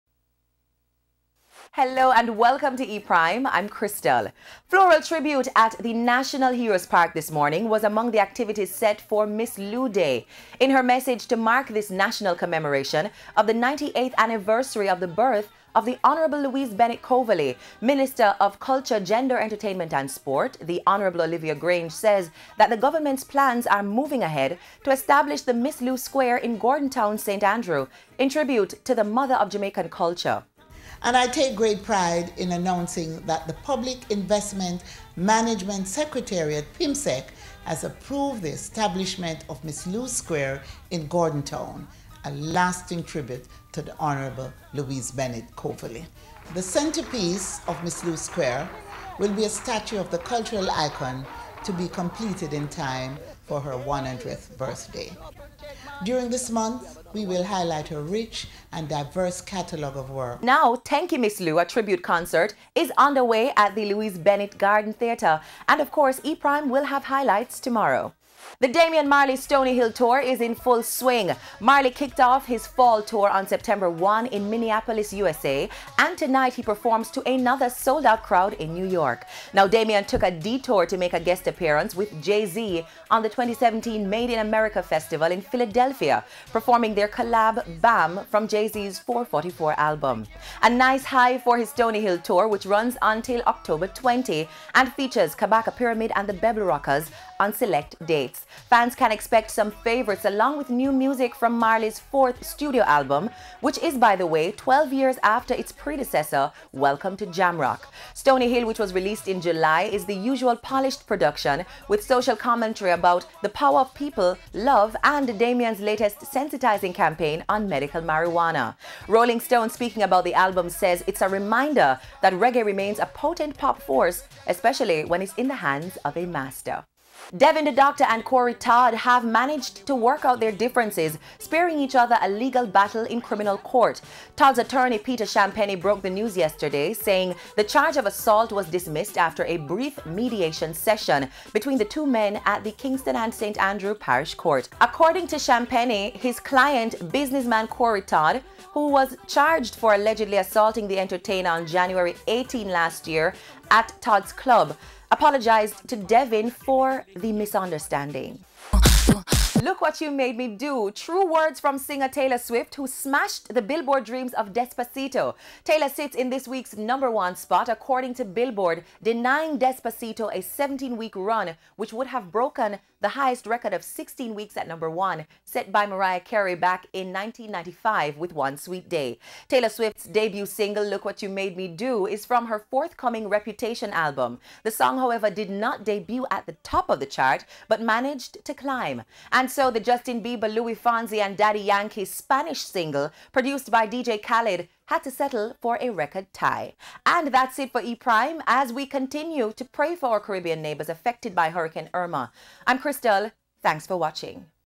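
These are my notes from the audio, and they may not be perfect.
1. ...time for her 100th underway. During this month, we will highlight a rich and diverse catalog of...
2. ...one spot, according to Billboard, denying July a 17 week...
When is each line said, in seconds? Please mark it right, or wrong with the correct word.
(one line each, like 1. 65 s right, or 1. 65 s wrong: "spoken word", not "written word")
1. 52 s wrong: "birthday", not "underway"
2. 167 s wrong: "Despacito", not "July".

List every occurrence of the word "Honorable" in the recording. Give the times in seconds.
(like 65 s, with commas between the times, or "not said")
16 s, 20 s, 43 s.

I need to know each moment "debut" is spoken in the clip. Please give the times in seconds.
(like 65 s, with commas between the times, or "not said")
180 s, 185 s.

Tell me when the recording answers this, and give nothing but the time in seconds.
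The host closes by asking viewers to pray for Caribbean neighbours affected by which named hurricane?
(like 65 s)
201 s.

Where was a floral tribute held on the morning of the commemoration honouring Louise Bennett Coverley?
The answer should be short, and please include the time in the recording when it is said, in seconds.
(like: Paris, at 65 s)
National Heroes Park, at 5 s.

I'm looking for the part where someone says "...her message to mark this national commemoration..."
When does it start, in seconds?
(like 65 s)
10 s.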